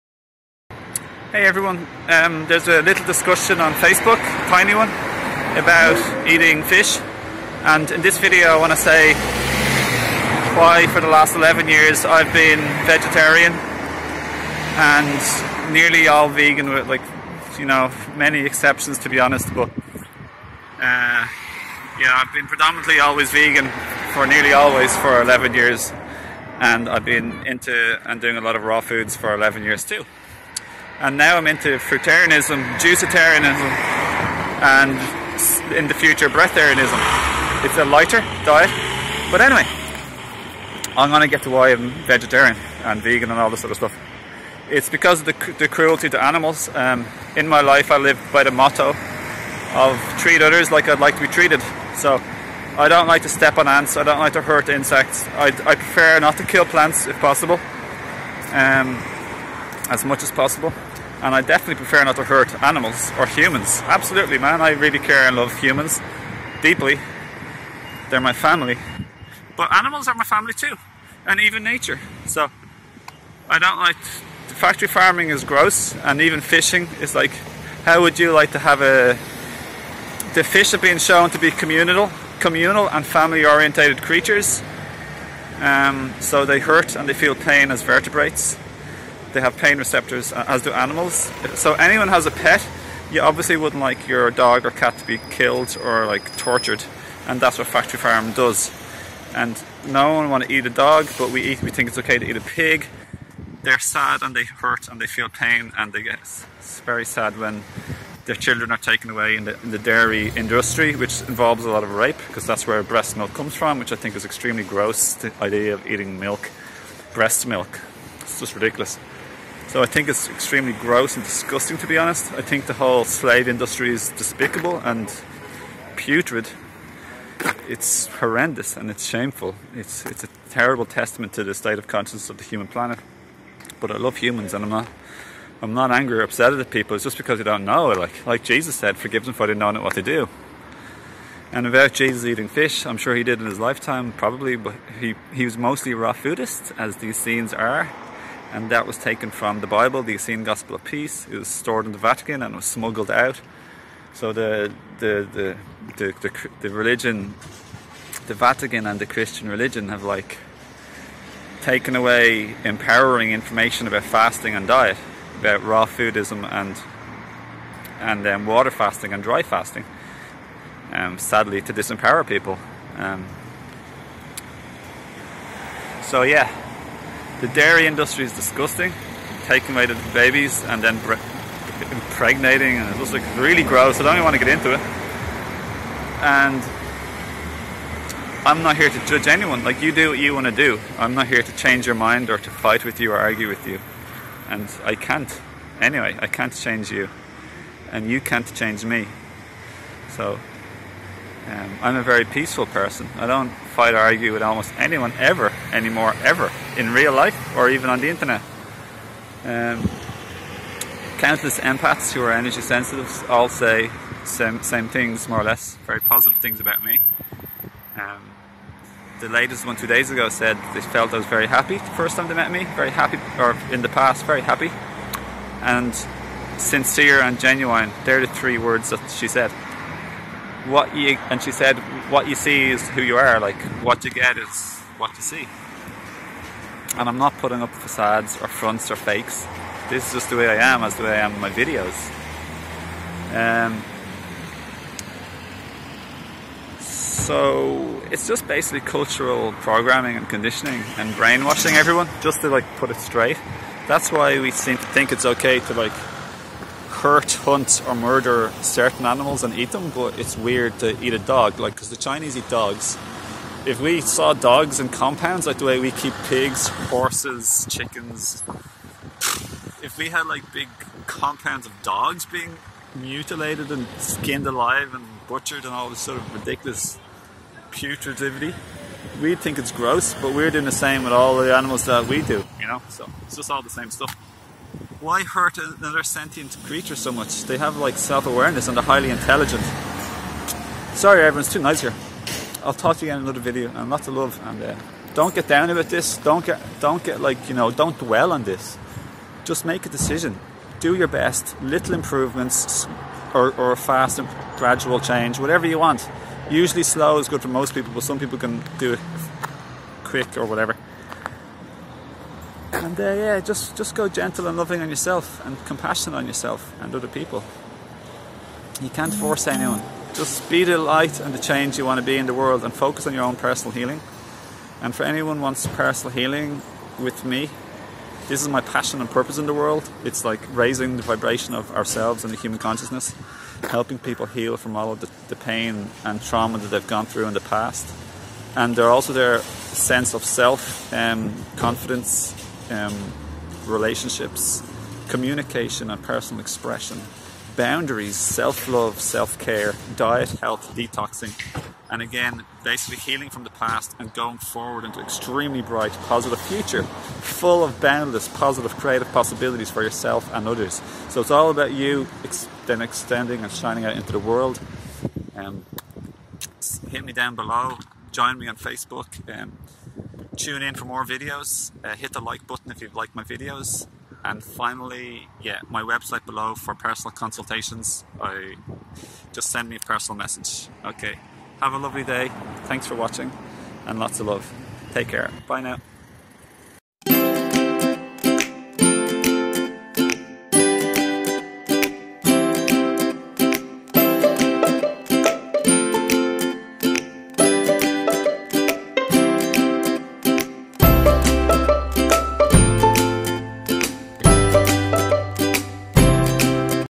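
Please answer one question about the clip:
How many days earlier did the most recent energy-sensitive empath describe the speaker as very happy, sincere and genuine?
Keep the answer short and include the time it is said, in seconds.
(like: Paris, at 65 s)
2, at 219 s.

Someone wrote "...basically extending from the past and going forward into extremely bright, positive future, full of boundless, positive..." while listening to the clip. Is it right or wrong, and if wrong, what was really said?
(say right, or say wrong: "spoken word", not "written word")
wrong: "healing", not "extending".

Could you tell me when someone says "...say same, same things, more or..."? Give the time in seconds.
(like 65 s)
213 s.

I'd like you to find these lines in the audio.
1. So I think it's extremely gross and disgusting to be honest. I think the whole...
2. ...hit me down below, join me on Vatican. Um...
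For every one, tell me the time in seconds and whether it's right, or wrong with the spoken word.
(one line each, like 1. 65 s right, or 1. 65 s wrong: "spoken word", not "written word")
1. 119 s right
2. 366 s wrong: "Facebook", not "Vatican".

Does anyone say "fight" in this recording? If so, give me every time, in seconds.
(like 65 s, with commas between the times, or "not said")
192 s, 203 s.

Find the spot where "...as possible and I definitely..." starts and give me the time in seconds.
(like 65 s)
60 s.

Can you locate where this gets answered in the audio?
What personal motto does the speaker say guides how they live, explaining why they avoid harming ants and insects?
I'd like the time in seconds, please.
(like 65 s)
50 s.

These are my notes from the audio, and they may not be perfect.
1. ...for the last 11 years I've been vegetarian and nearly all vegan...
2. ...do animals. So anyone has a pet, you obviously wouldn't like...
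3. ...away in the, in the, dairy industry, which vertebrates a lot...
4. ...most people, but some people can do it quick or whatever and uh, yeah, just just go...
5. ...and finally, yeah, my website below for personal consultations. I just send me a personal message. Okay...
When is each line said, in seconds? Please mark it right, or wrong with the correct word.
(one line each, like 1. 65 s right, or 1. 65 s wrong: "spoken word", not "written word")
1. 10 s right
2. 90 s right
3. 109 s wrong: "involves", not "vertebrates"
4. 307 s right
5. 374 s right.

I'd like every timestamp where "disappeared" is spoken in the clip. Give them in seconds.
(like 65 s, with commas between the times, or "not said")
not said.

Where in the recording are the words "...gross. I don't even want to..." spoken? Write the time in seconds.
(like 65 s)
183 s.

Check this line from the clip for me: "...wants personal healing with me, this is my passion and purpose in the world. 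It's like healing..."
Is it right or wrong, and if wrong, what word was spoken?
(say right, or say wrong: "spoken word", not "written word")
wrong: "raising", not "healing".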